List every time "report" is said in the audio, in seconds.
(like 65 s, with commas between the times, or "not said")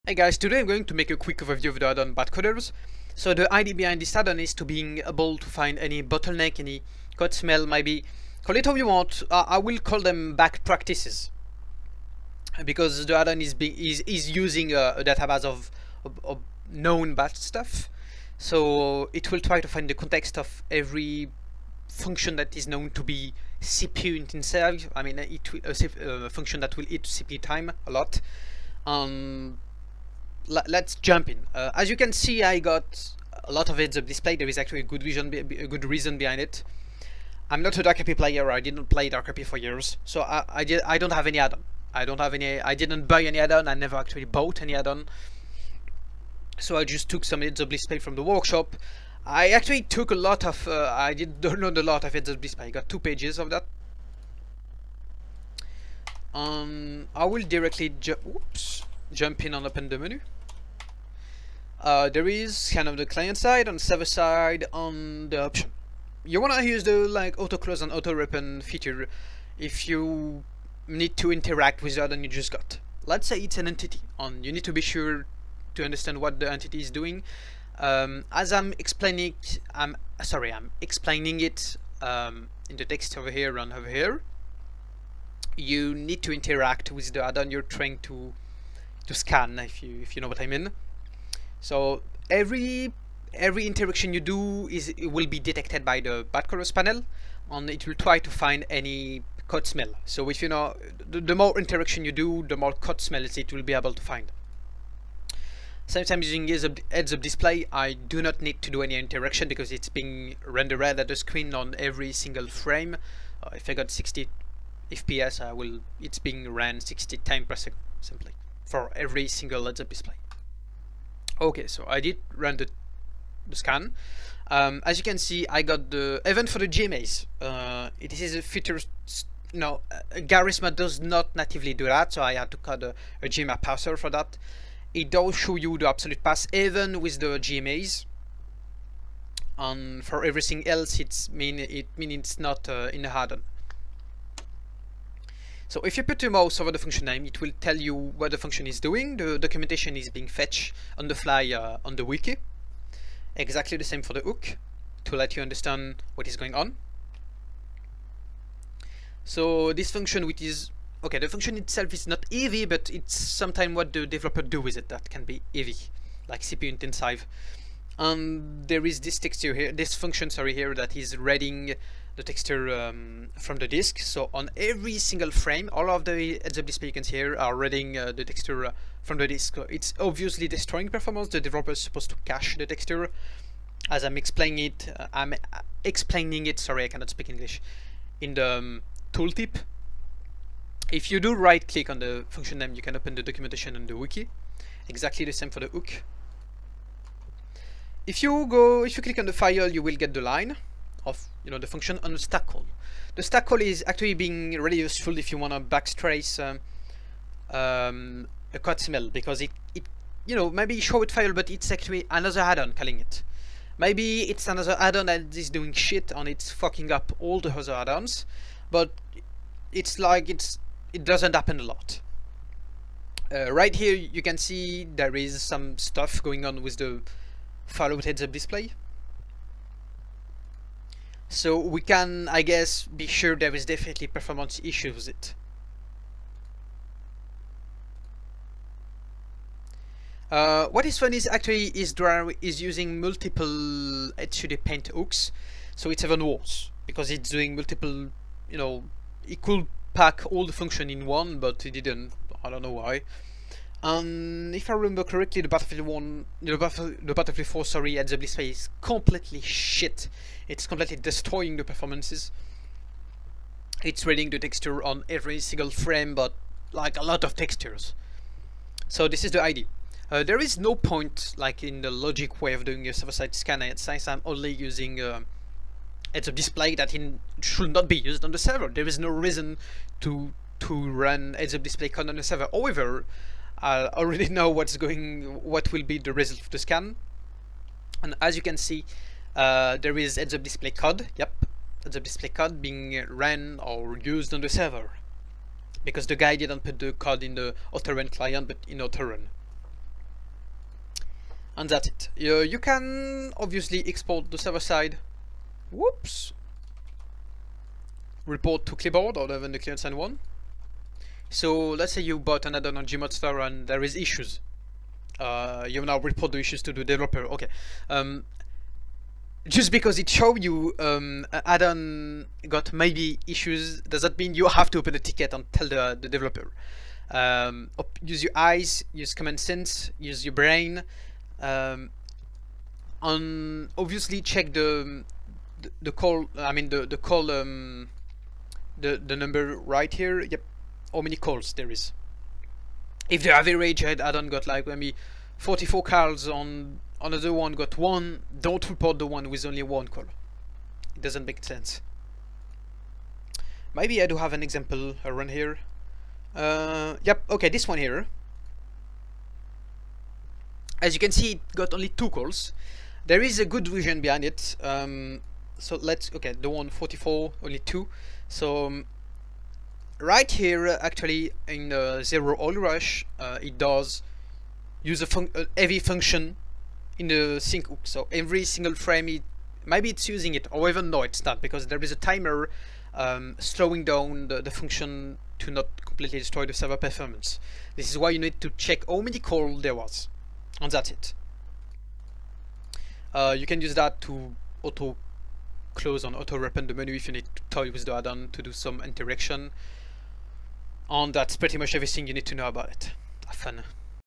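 308 s, 315 s, 348 s.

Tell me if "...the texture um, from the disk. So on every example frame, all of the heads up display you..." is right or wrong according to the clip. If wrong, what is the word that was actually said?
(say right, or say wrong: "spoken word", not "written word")
wrong: "single", not "example".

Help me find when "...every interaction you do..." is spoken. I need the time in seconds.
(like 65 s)
93 s.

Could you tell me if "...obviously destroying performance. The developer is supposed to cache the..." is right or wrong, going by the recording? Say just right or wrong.
right.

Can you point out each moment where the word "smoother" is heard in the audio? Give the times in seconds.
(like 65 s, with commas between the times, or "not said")
not said.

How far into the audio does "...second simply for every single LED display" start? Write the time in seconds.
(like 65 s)
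117 s.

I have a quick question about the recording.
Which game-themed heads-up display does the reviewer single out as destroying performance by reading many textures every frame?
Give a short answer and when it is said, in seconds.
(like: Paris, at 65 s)
Battlefield 4, at 257 s.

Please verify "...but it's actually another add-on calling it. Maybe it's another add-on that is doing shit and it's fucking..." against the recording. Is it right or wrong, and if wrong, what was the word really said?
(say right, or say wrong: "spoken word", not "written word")
right.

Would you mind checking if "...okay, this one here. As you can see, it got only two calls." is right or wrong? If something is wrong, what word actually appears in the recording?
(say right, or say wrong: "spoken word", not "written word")
right.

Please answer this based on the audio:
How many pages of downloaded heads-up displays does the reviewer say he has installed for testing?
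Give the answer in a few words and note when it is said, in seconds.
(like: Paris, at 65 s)
2, at 52 s.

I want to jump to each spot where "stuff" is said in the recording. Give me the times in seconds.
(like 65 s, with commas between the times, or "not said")
17 s, 225 s.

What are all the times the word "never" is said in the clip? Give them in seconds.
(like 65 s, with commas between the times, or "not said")
43 s.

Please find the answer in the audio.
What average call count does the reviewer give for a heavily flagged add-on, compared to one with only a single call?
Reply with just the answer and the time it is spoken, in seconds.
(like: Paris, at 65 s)
44, at 345 s.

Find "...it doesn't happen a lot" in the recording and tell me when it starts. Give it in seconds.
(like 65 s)
220 s.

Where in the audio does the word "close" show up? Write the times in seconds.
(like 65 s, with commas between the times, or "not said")
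67 s, 395 s.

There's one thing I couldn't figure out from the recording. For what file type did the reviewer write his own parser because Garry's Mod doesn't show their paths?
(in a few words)
GMA.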